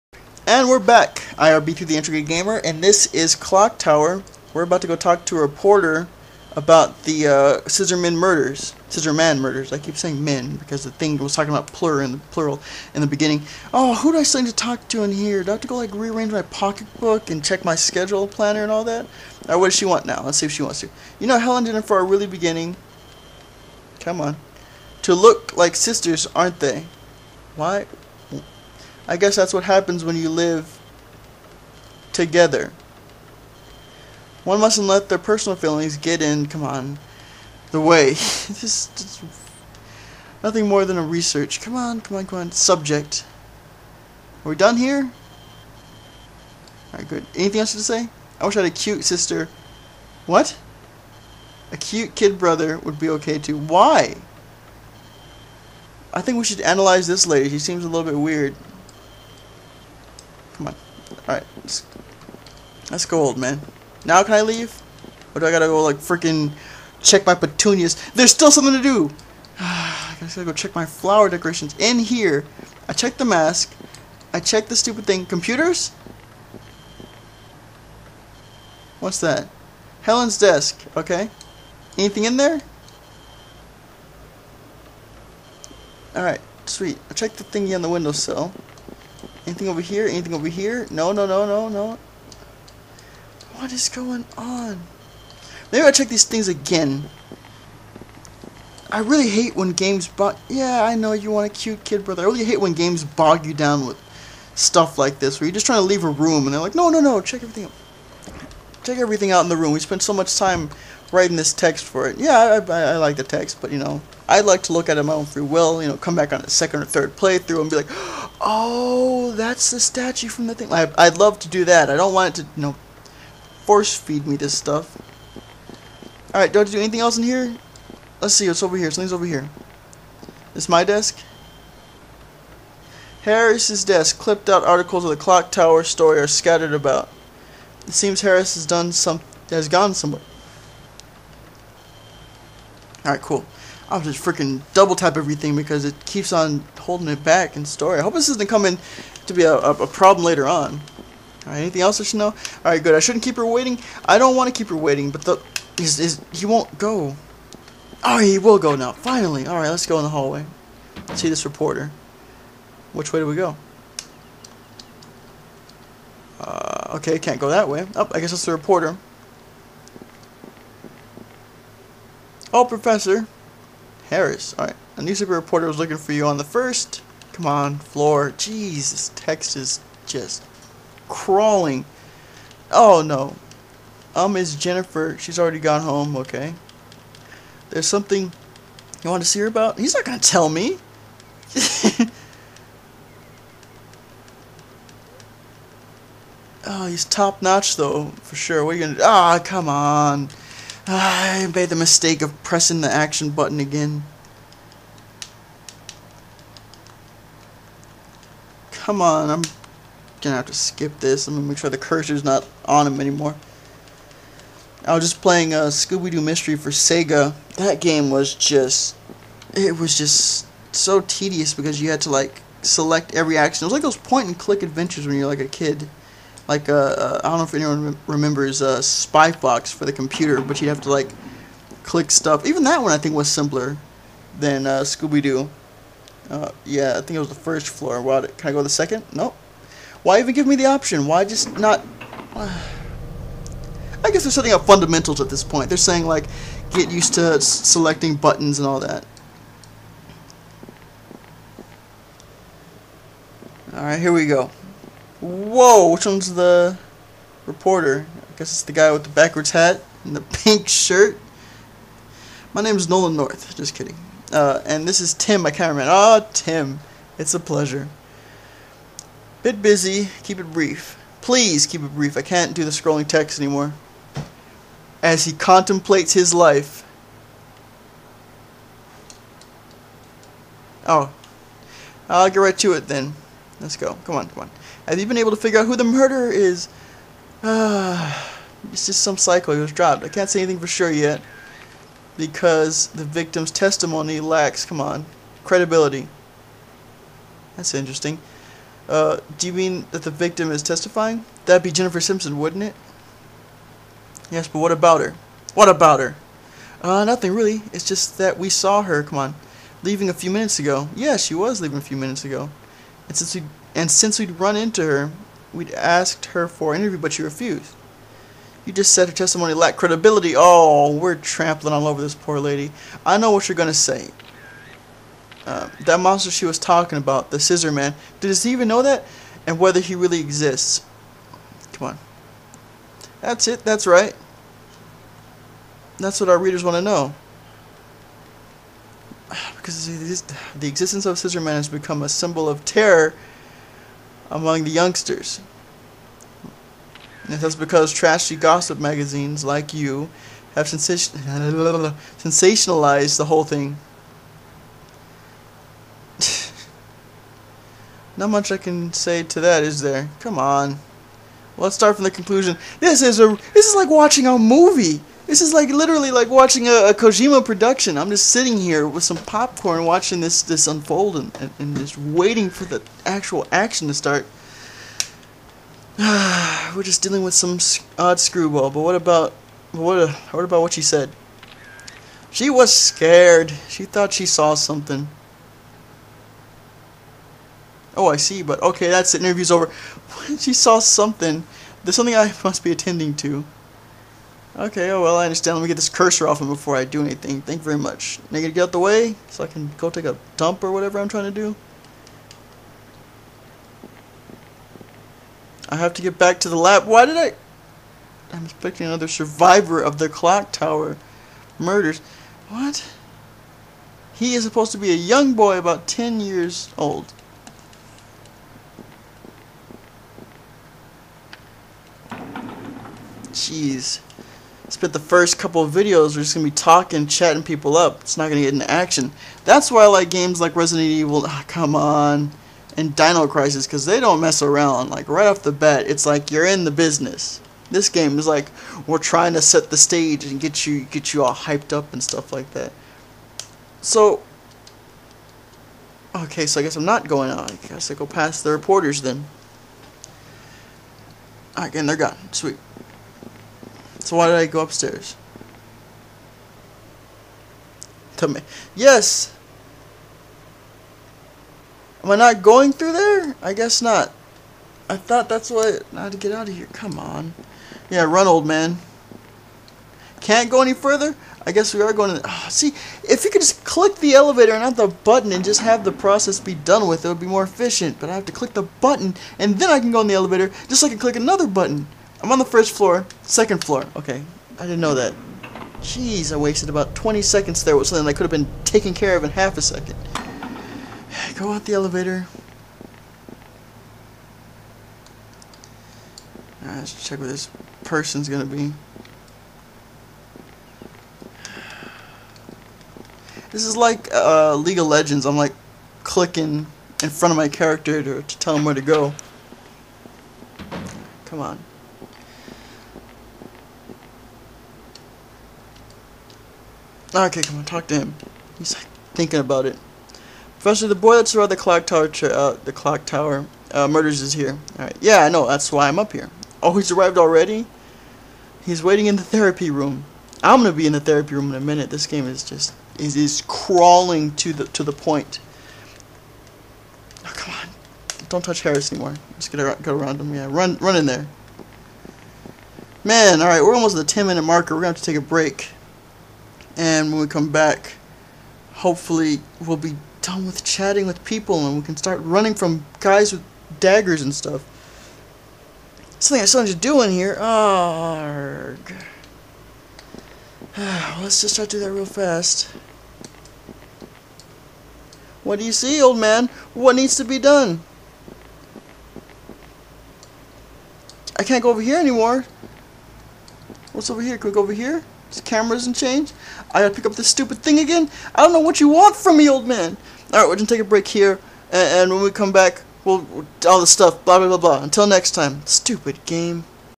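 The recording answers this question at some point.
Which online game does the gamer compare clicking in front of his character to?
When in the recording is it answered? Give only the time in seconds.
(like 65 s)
504 s.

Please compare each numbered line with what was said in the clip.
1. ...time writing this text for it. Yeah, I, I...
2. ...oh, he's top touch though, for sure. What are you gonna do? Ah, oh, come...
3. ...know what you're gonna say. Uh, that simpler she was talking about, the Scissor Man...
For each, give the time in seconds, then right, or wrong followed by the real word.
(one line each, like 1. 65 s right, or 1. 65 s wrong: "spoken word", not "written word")
1. 110 s right
2. 196 s wrong: "notch", not "touch"
3. 323 s wrong: "monster", not "simpler".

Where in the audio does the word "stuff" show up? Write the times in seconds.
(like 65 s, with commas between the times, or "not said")
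104 s, 124 s, 232 s, 442 s, 554 s, 583 s.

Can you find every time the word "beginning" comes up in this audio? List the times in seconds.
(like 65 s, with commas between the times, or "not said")
13 s, 22 s.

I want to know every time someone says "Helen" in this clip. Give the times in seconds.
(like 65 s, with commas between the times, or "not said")
21 s, 80 s.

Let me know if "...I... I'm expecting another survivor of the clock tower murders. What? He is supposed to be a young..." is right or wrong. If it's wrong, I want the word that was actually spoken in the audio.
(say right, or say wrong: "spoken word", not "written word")
right.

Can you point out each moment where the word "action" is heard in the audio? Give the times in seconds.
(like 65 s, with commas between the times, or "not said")
202 s, 223 s, 373 s, 428 s.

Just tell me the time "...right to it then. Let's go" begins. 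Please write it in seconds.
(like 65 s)
282 s.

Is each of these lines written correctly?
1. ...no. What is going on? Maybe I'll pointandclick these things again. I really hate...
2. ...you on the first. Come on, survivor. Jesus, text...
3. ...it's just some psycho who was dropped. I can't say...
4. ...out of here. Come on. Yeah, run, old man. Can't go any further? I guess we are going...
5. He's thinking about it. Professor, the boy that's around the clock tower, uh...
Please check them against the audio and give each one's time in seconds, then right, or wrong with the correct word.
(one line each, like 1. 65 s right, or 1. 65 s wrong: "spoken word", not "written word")
1. 91 s wrong: "check", not "pointandclick"
2. 176 s wrong: "floor", not "survivor"
3. 288 s right
4. 466 s right
5. 518 s right.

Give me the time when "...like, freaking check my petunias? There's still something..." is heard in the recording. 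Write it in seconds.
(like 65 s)
65 s.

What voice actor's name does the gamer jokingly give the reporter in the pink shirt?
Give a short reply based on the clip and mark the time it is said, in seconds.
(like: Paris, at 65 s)
Nolan North, at 262 s.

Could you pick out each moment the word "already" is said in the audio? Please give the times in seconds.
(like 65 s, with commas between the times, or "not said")
185 s, 527 s.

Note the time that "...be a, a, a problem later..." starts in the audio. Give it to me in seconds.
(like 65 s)
149 s.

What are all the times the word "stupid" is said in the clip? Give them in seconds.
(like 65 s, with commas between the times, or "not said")
74 s, 577 s, 585 s.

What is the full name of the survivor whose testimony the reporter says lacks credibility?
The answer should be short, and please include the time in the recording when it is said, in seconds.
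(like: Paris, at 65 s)
Jennifer Simpson, at 301 s.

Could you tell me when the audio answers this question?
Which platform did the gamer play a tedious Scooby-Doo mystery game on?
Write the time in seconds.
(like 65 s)
216 s.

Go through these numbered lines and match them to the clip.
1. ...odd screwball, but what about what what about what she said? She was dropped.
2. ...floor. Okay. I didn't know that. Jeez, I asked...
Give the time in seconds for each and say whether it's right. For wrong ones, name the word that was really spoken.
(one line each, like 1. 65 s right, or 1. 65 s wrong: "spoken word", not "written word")
1. 377 s wrong: "scared", not "dropped"
2. 483 s wrong: "wasted", not "asked".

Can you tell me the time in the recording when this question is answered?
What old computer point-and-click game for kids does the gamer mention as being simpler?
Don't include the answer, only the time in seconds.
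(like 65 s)
228 s.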